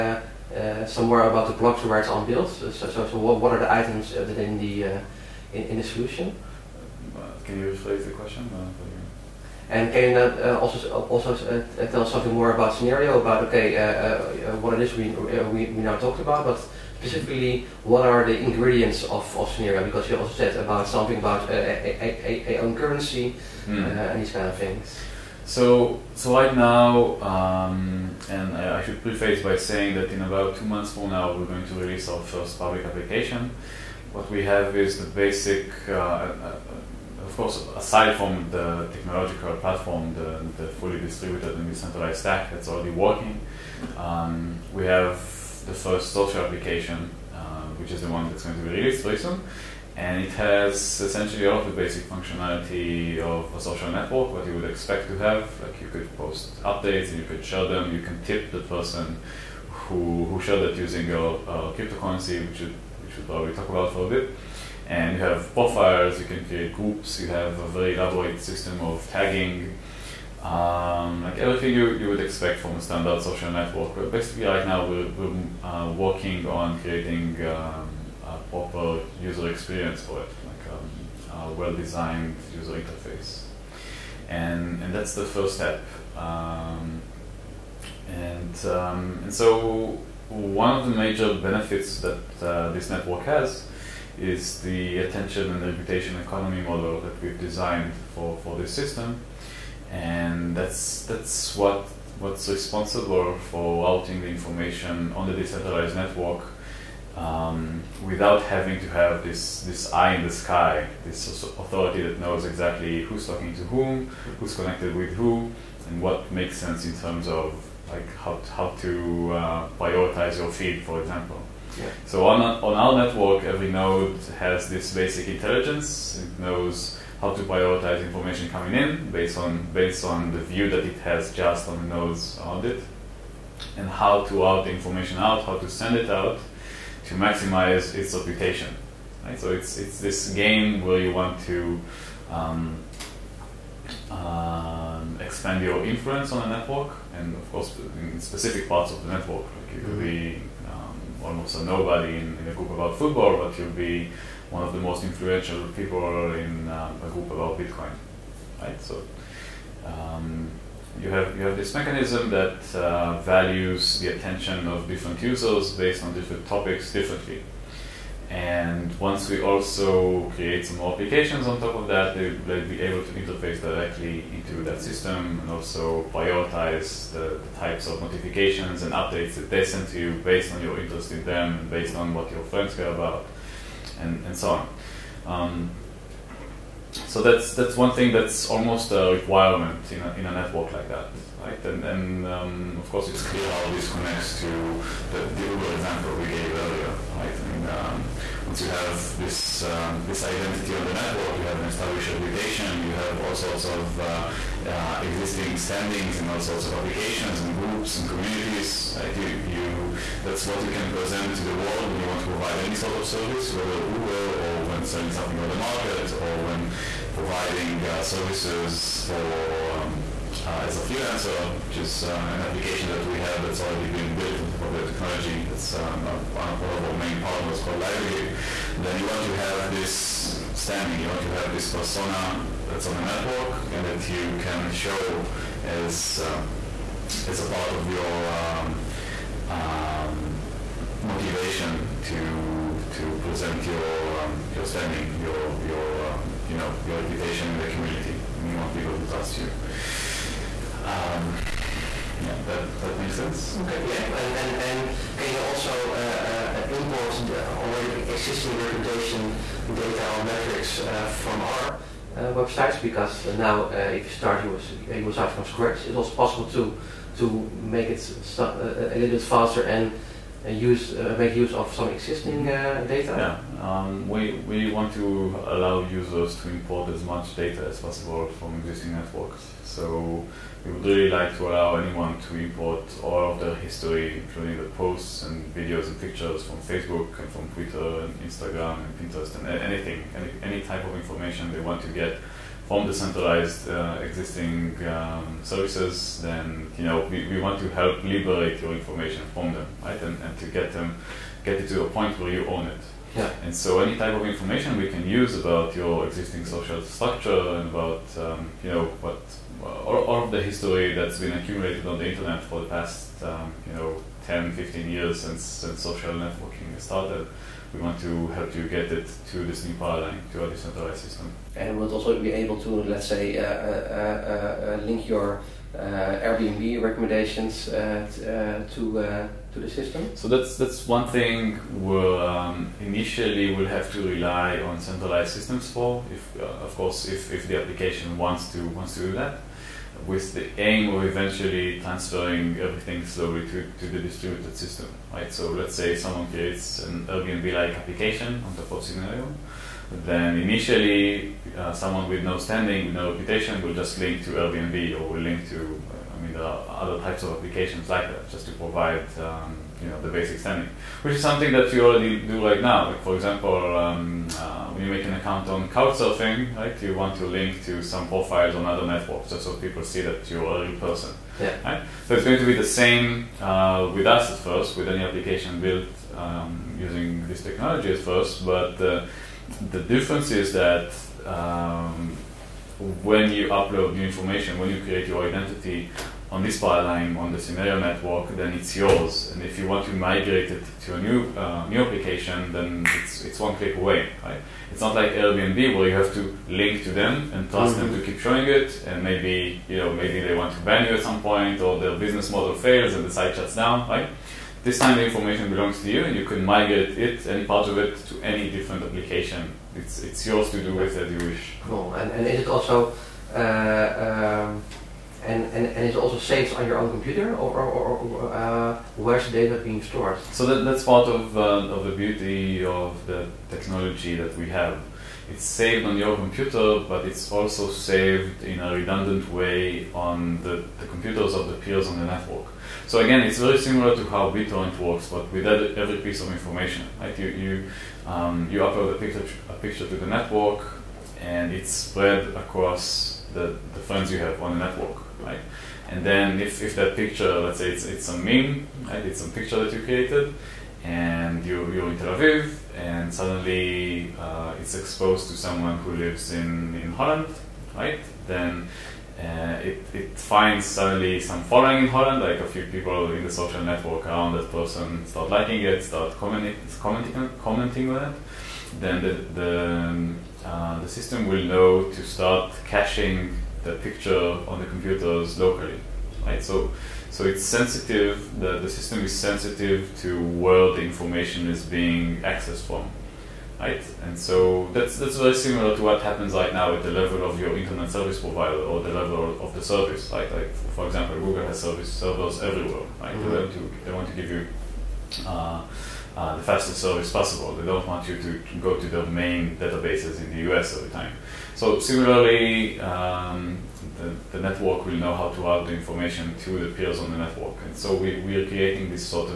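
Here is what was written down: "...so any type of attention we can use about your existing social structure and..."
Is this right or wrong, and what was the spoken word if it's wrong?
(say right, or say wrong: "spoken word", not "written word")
wrong: "information", not "attention".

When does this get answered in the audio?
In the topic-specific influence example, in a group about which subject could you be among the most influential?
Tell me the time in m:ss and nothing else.
2:37.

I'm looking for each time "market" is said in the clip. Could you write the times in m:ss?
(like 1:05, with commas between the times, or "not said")
3:35.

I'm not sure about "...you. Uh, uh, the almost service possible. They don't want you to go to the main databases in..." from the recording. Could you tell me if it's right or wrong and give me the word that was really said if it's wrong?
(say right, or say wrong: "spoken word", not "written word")
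wrong: "fastest", not "almost".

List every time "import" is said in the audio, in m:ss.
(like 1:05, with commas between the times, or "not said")
4:16, 4:36, 4:42.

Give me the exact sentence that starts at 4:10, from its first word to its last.
Um, yeah, that, that makes sense.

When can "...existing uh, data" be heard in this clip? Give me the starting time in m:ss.
4:31.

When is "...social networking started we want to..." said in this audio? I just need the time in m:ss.
5:15.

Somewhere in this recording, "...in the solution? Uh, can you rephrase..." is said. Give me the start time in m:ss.
0:05.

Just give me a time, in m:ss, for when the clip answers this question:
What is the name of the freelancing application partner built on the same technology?
3:47.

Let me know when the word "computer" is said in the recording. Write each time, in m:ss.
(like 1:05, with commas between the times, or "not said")
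6:56, 7:06, 7:10, 7:54.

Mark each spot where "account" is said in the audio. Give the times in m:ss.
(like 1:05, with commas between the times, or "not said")
6:05.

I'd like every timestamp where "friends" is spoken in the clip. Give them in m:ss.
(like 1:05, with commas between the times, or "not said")
3:02, 7:23.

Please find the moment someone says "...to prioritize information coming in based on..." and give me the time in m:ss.
2:07.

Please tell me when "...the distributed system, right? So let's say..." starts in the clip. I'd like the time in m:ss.
5:43.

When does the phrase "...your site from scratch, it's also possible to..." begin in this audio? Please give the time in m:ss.
4:24.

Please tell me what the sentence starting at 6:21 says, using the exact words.
Um, when you upload new information, when you create your identity, on this pipeline, on the Synereo network, then it's yours.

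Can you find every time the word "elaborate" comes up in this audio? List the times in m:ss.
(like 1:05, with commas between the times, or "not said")
1:07.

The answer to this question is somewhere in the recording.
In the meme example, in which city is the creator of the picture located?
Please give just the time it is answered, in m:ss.
7:31.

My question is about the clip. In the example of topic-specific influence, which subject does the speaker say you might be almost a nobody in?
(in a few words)
Football.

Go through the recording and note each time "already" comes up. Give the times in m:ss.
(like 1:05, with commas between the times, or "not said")
0:42, 3:43, 4:17, 6:01.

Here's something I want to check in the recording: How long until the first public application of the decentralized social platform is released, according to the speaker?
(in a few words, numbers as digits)
2 months.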